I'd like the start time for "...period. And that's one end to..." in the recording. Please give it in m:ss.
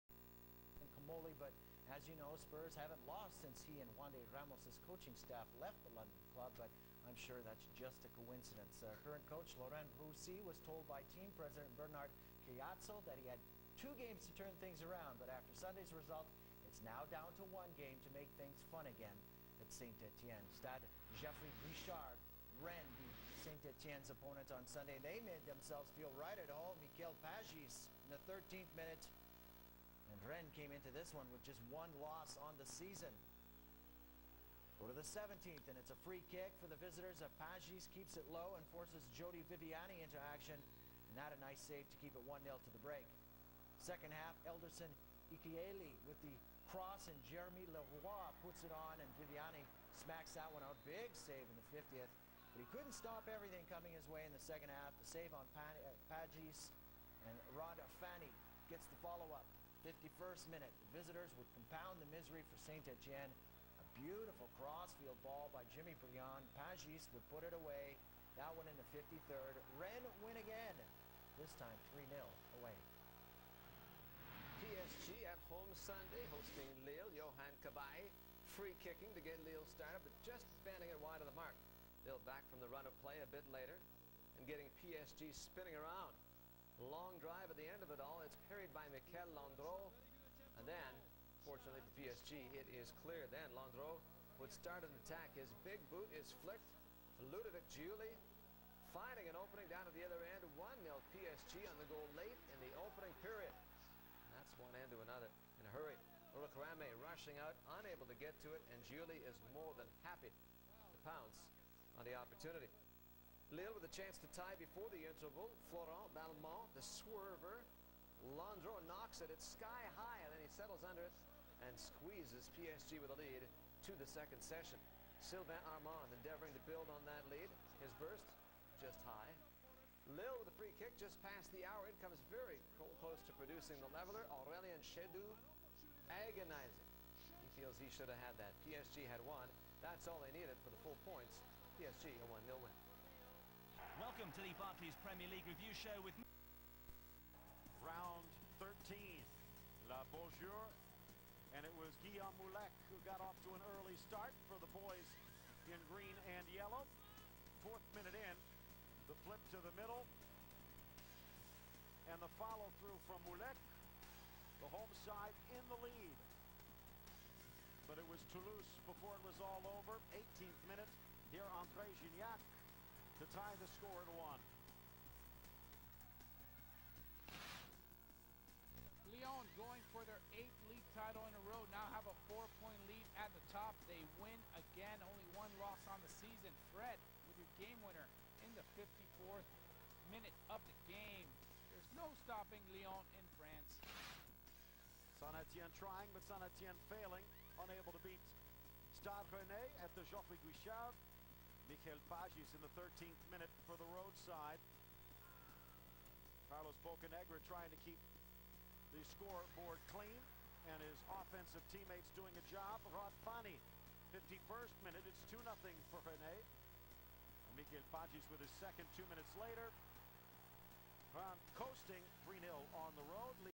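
1:43.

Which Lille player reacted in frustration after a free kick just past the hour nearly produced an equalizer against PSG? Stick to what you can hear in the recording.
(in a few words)
Aurelien Chedjou.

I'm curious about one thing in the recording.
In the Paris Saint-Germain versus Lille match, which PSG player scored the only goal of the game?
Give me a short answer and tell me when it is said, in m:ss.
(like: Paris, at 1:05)
Ludovic Giuli, at 1:37.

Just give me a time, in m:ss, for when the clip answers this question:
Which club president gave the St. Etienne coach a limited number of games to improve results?
0:11.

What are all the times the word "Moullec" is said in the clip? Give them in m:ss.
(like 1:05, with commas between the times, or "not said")
2:32, 2:43.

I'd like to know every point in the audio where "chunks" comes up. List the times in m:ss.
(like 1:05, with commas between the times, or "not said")
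not said.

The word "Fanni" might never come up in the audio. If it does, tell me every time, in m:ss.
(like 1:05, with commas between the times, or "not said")
0:58, 3:33.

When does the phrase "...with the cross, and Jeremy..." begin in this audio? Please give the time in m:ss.
0:46.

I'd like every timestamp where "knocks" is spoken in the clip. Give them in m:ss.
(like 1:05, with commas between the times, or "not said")
1:58.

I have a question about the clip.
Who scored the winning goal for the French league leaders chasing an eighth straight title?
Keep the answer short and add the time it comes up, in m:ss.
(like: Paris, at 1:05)
Fred, at 3:06.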